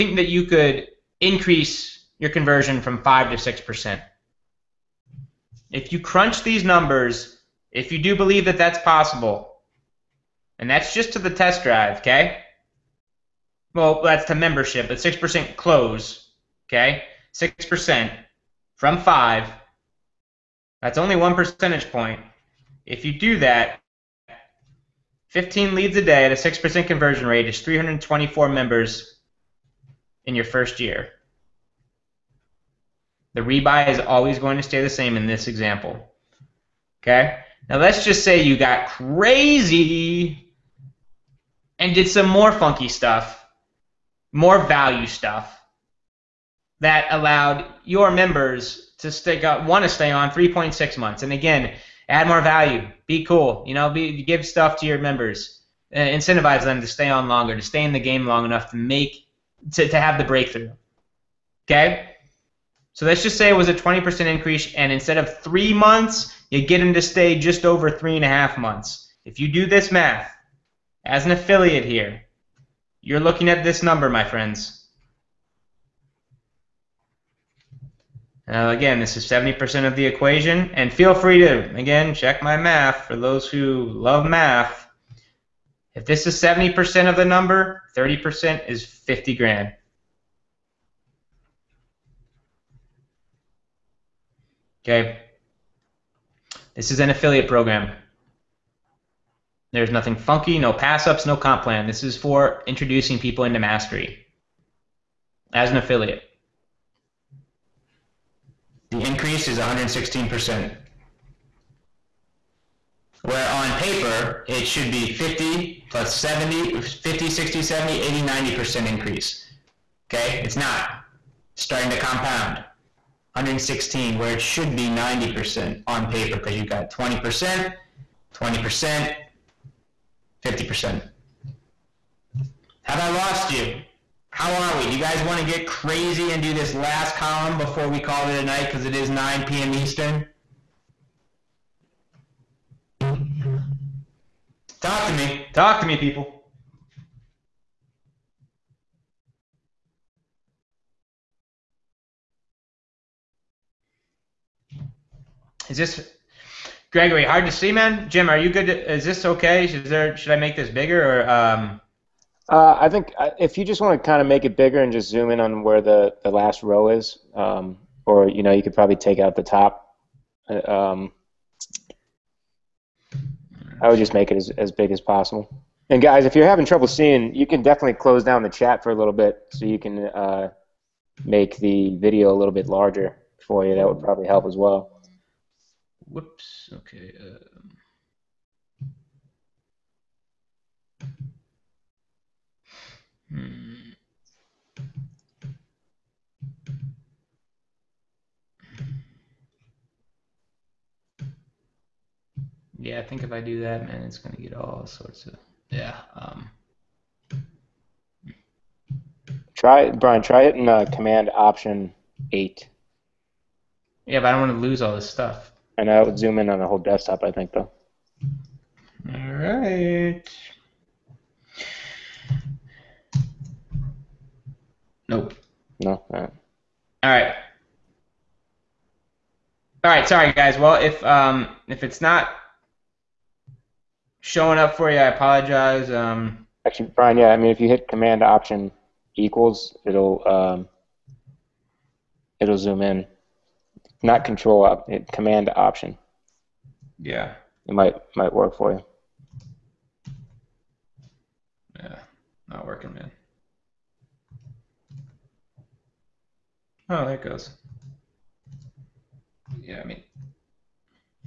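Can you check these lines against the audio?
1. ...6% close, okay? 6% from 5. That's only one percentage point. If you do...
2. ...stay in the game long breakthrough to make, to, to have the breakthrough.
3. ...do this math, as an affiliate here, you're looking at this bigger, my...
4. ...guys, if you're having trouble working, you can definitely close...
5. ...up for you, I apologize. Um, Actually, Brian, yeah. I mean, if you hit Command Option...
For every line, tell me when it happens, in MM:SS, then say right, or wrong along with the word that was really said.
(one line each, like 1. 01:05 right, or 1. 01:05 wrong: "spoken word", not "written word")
1. 00:14 right
2. 00:57 wrong: "enough", not "breakthrough"
3. 01:09 wrong: "number", not "bigger"
4. 02:56 wrong: "seeing", not "working"
5. 03:54 right.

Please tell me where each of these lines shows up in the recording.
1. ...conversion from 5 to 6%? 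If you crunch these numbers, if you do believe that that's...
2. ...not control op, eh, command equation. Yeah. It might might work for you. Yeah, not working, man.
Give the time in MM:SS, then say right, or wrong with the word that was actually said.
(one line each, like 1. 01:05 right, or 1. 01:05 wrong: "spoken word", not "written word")
1. 00:02 right
2. 04:04 wrong: "option", not "equation".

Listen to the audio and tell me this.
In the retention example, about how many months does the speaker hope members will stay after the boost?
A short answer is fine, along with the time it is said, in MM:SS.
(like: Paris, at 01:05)
3.6 months, at 00:50.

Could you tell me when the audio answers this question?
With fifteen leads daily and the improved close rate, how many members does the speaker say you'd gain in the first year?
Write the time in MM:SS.
00:27.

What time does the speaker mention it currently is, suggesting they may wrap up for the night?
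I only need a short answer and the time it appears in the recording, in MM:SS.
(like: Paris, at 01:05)
9 p.m. Eastern, at 02:19.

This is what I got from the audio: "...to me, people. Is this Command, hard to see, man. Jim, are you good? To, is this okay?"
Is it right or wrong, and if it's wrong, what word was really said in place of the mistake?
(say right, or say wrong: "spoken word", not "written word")
wrong: "Gregory", not "Command".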